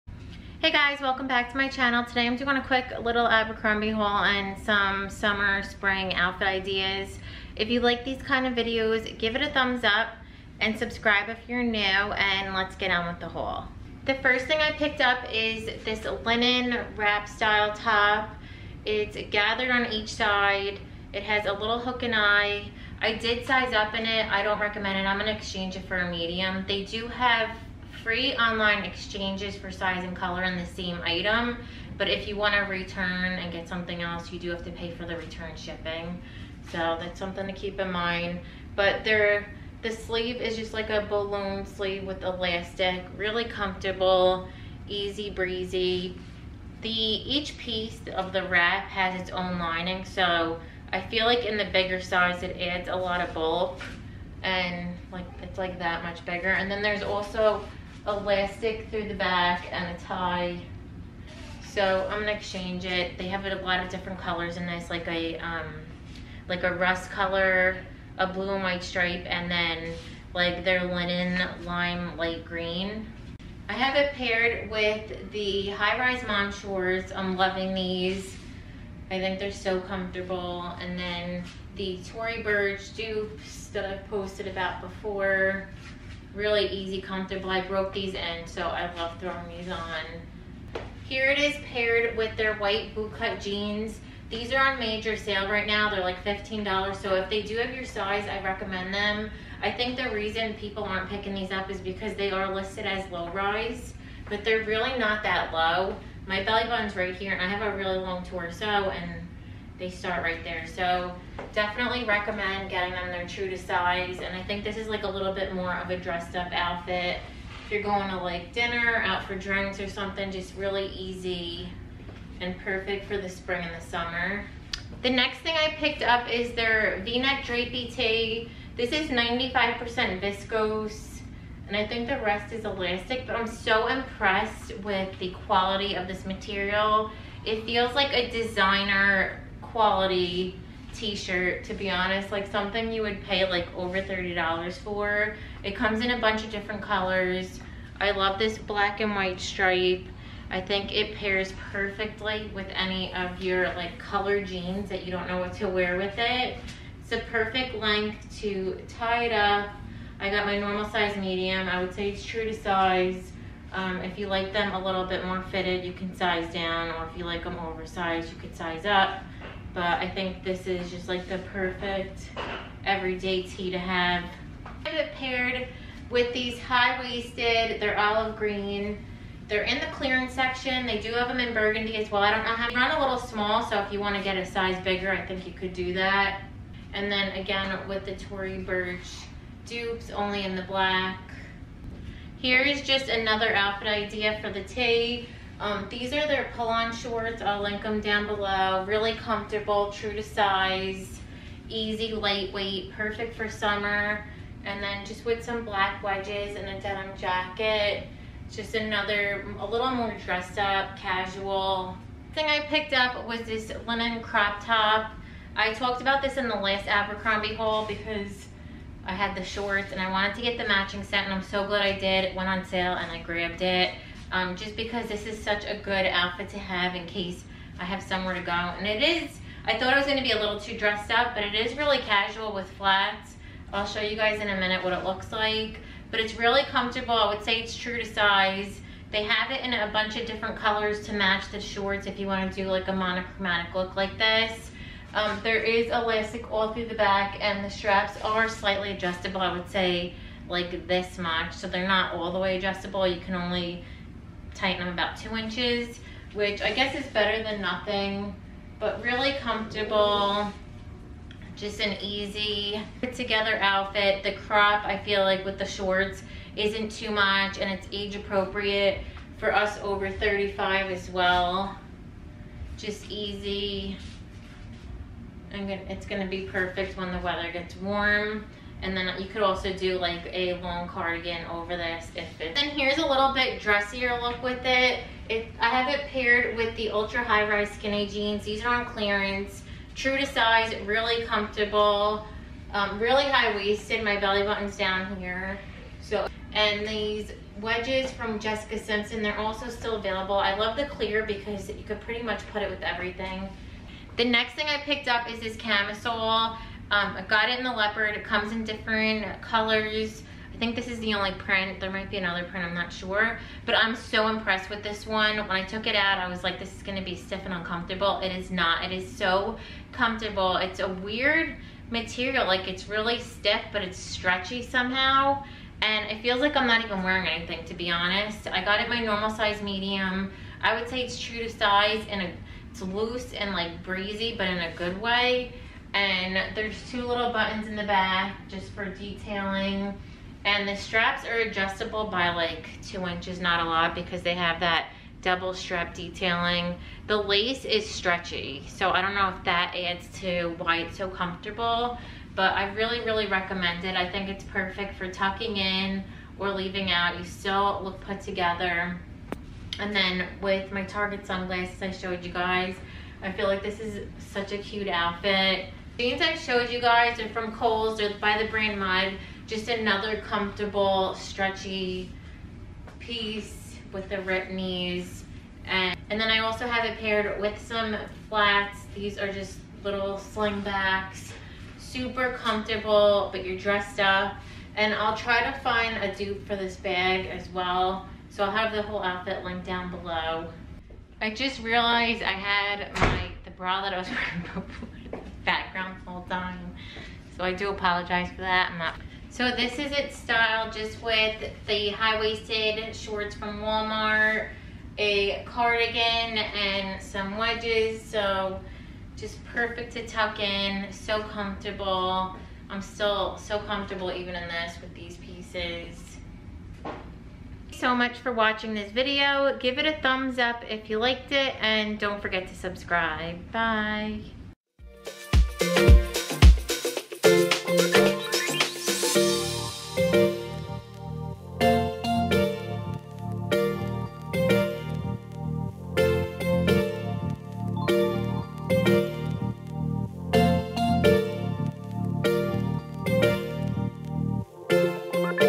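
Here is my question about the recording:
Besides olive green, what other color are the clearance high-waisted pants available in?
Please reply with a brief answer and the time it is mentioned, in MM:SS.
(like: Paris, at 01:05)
burgundy, at 03:01.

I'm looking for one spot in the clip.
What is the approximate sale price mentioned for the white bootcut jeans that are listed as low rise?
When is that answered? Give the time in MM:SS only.
01:36.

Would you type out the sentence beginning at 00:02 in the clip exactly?
Today I'm doing a quick little Abercrombie haul and some summer, spring outfit ideas.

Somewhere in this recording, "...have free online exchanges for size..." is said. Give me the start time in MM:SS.
00:27.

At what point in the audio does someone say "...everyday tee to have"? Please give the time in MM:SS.
02:52.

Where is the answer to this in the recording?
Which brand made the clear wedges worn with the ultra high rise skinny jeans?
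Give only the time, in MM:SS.
04:58.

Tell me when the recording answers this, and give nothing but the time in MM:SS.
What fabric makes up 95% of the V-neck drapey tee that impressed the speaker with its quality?
02:10.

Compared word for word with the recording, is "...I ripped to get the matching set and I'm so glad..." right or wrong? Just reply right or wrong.
wrong.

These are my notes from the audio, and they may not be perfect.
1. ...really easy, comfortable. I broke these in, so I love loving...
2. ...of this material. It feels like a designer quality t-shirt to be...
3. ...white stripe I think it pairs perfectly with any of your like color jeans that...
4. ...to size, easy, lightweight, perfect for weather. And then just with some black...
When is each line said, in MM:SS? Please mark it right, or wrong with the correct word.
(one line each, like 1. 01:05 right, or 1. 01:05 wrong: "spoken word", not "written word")
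1. 01:26 wrong: "throwing", not "loving"
2. 02:15 right
3. 02:29 right
4. 03:20 wrong: "summer", not "weather".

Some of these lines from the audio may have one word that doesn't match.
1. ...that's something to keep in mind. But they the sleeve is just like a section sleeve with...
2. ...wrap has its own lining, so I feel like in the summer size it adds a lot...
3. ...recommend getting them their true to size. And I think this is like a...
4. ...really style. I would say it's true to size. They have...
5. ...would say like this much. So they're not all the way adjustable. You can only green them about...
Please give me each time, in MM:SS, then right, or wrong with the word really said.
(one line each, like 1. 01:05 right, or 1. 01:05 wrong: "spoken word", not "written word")
1. 00:36 wrong: "balloon", not "section"
2. 00:48 wrong: "bigger", not "summer"
3. 01:52 right
4. 03:56 wrong: "comfortable", not "style"
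5. 04:09 wrong: "tighten", not "green".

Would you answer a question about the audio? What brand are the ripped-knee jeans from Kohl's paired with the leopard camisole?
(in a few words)
Mudd.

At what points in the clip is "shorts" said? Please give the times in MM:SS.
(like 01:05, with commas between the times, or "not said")
01:16, 03:16, 03:39, 04:01, 04:25, 06:42.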